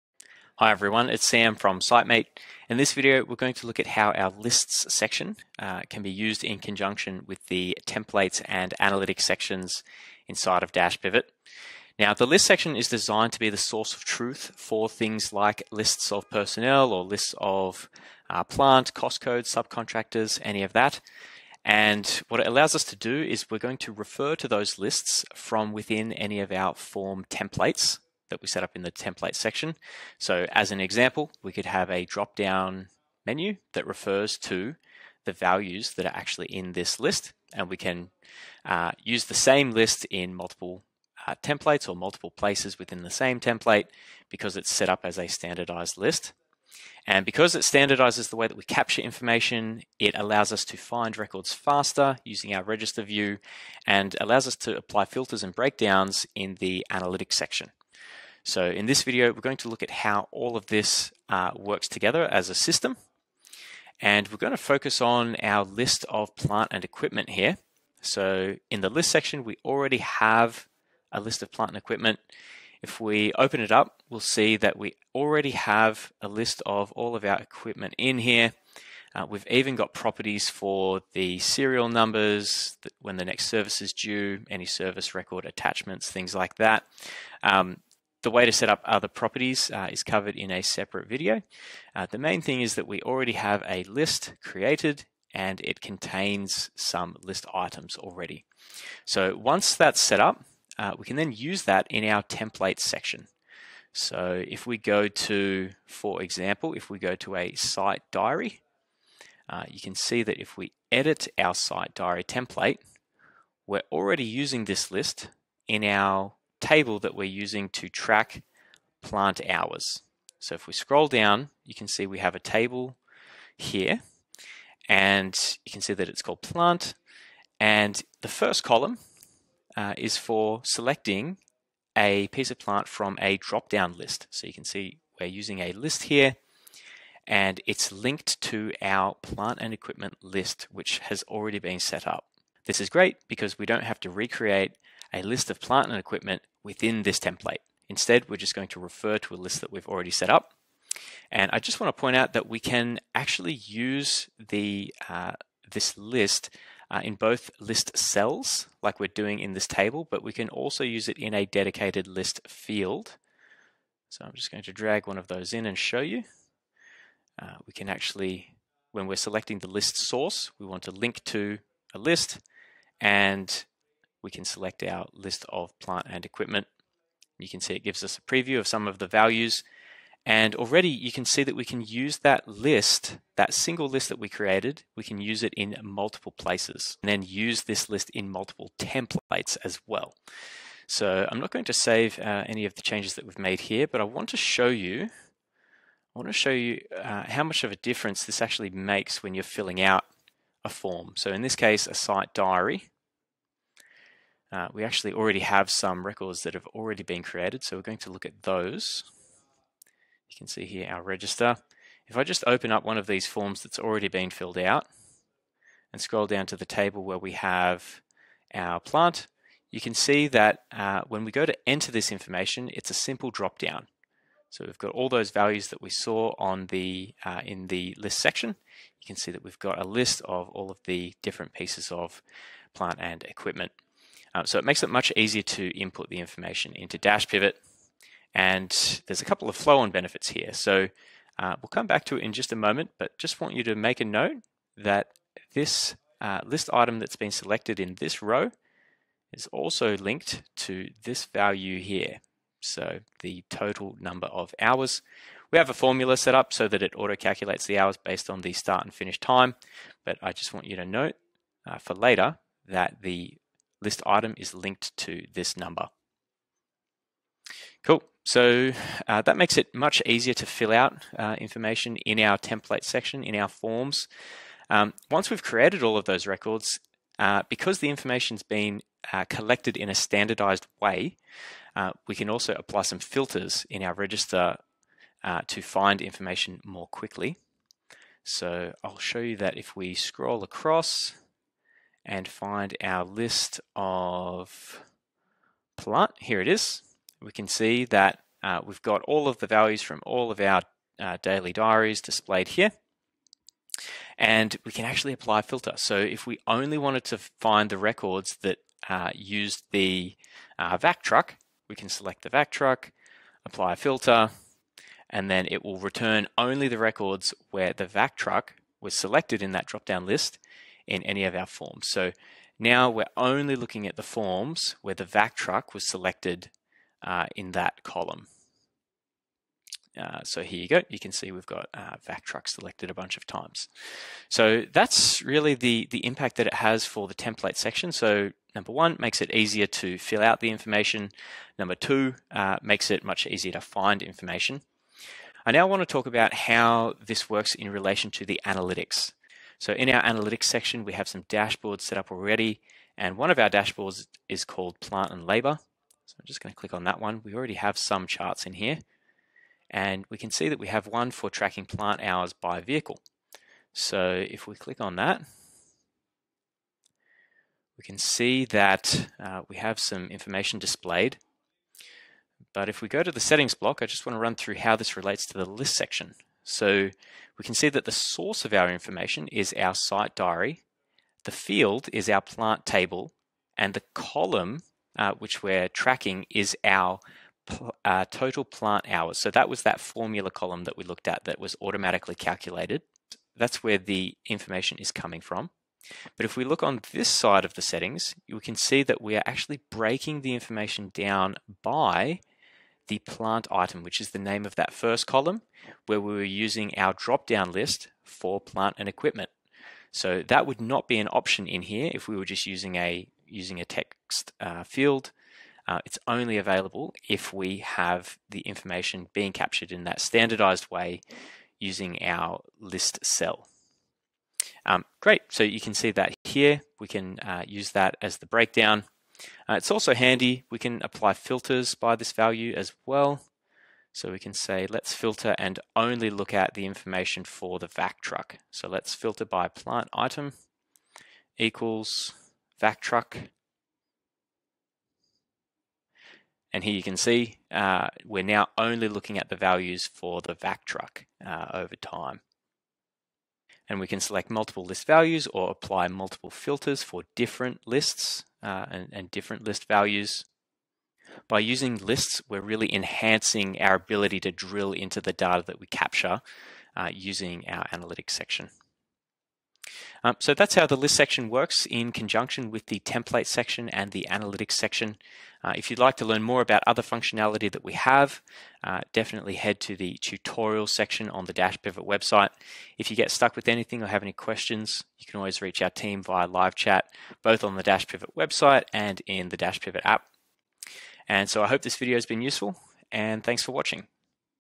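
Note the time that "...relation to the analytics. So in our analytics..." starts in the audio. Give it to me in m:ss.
5:47.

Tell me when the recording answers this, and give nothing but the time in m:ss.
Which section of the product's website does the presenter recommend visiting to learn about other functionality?
7:59.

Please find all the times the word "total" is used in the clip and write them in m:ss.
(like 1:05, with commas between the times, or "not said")
4:13, 6:28.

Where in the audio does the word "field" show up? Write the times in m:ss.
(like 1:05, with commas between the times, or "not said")
2:42, 6:21, 6:54.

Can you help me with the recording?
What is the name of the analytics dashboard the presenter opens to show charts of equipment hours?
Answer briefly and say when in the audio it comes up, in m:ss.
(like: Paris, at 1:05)
plant and labor, at 5:54.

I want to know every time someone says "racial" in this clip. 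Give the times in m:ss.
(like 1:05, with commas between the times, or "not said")
not said.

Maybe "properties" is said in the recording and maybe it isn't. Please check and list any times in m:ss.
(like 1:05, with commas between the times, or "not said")
1:19, 1:29.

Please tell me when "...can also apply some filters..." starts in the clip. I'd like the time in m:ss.
4:42.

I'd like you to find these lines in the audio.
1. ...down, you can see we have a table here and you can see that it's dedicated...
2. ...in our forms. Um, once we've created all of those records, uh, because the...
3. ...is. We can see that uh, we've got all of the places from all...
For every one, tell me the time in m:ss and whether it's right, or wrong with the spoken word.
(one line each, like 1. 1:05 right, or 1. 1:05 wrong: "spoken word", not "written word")
1. 2:01 wrong: "called", not "dedicated"
2. 4:33 right
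3. 4:56 wrong: "values", not "places".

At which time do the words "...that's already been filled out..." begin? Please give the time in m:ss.
3:33.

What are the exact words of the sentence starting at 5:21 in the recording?
So now we're only looking at the forms where the vac truck was selected uh, in that column.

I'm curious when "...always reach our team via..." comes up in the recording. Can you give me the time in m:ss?
8:05.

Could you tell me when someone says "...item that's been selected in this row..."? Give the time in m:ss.
4:06.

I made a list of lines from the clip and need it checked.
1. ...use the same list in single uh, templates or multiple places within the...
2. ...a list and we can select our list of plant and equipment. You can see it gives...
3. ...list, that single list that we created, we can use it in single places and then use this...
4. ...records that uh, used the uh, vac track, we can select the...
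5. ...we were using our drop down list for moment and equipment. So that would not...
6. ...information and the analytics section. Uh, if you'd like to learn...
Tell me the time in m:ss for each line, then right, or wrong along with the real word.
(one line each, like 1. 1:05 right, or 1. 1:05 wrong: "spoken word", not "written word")
1. 0:39 wrong: "multiple", not "single"
2. 2:51 right
3. 3:02 wrong: "multiple", not "single"
4. 5:07 wrong: "truck", not "track"
5. 6:46 wrong: "plant", not "moment"
6. 7:53 wrong: "section", not "information".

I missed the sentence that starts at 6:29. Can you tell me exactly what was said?
So that was that formula column that we looked at that was automatically calculated.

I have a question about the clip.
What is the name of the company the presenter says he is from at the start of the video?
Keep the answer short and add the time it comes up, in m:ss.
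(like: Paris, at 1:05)
Sitemate, at 0:01.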